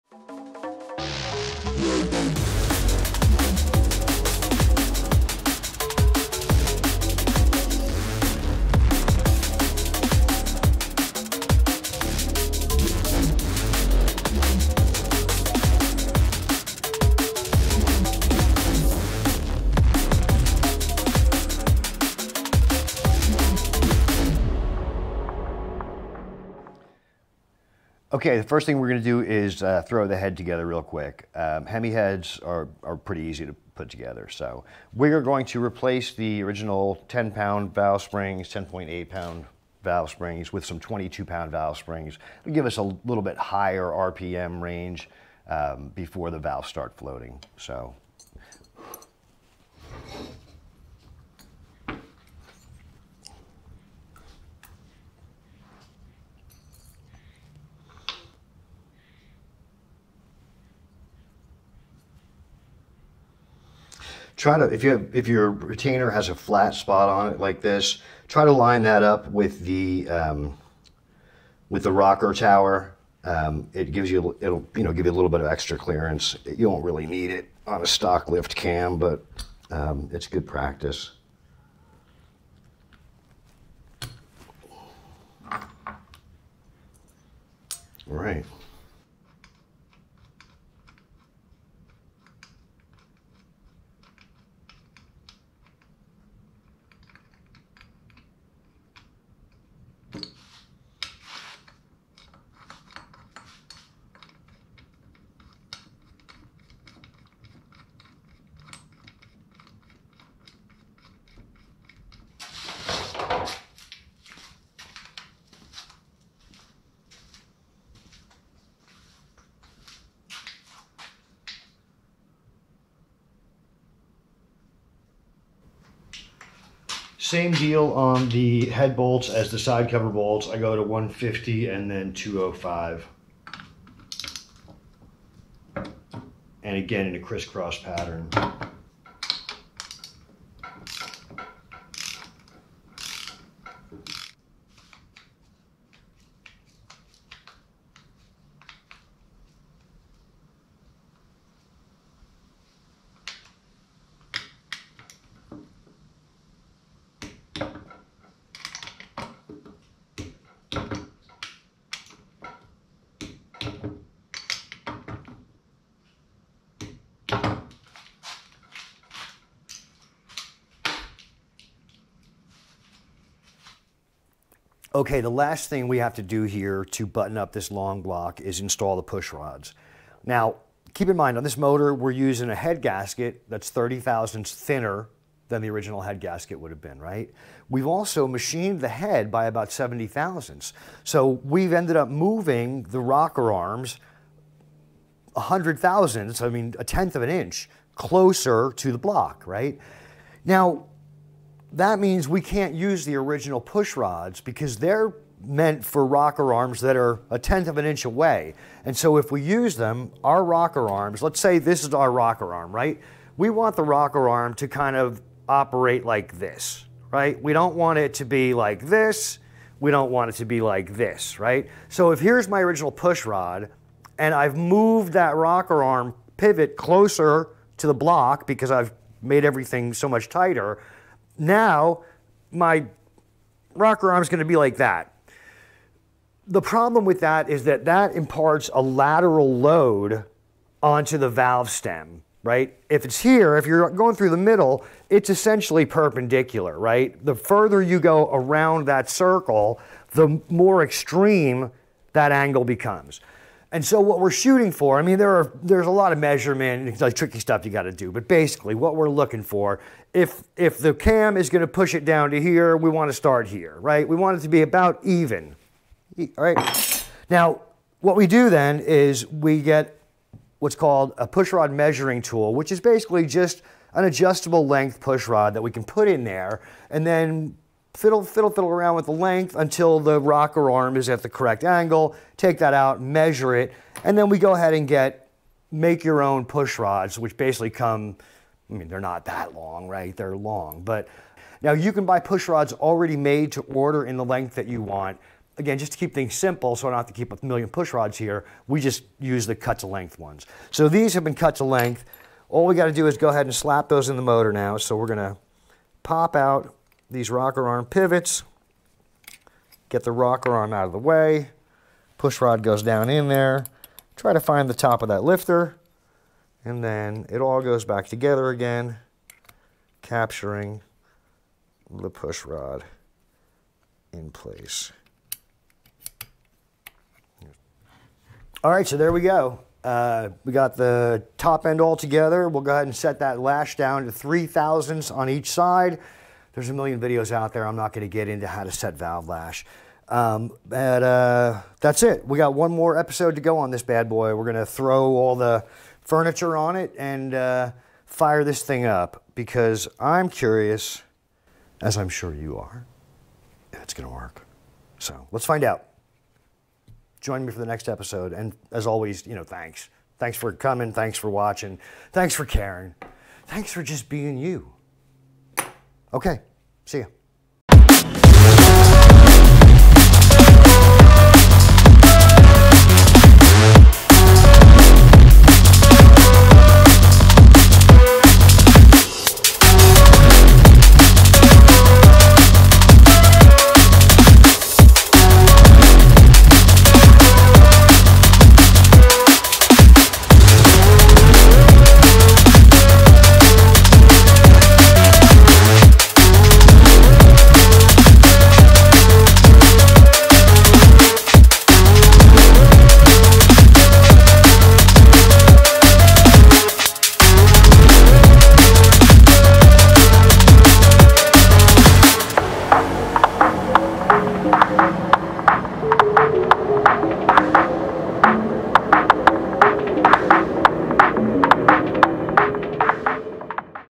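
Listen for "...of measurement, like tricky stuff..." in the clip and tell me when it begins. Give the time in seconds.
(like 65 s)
256 s.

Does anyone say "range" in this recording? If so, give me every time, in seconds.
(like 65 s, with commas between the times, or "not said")
44 s.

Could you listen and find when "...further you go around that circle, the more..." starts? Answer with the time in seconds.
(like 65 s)
247 s.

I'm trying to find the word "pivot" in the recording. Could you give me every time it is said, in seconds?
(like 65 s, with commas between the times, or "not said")
226 s, 307 s.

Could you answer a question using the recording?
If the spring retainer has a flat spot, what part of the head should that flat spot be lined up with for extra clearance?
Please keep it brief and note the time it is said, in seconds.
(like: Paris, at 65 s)
rocker tower, at 71 s.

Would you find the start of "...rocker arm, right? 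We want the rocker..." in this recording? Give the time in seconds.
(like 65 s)
212 s.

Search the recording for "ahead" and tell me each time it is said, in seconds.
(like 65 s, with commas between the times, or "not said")
284 s, 303 s, 332 s.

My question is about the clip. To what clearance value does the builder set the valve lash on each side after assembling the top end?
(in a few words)
3 thousandths.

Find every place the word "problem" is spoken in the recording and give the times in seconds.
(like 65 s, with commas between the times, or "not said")
236 s.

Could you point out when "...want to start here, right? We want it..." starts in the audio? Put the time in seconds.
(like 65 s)
262 s.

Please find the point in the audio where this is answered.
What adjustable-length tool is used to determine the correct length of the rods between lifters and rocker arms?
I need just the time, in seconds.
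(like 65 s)
271 s.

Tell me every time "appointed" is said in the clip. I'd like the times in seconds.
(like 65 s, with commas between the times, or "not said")
not said.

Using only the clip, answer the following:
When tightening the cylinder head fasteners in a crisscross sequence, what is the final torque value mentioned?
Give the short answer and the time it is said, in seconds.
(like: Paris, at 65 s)
205, at 132 s.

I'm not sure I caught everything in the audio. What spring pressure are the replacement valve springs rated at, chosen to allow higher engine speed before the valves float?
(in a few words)
22 pound.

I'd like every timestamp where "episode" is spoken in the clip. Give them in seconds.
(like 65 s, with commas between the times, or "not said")
342 s, 357 s.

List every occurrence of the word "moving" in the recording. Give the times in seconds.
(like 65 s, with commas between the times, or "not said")
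192 s.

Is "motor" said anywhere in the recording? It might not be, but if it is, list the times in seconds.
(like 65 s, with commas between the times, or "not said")
181 s, 304 s.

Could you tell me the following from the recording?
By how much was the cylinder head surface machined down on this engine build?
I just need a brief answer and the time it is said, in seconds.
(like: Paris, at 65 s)
70 thousandths, at 189 s.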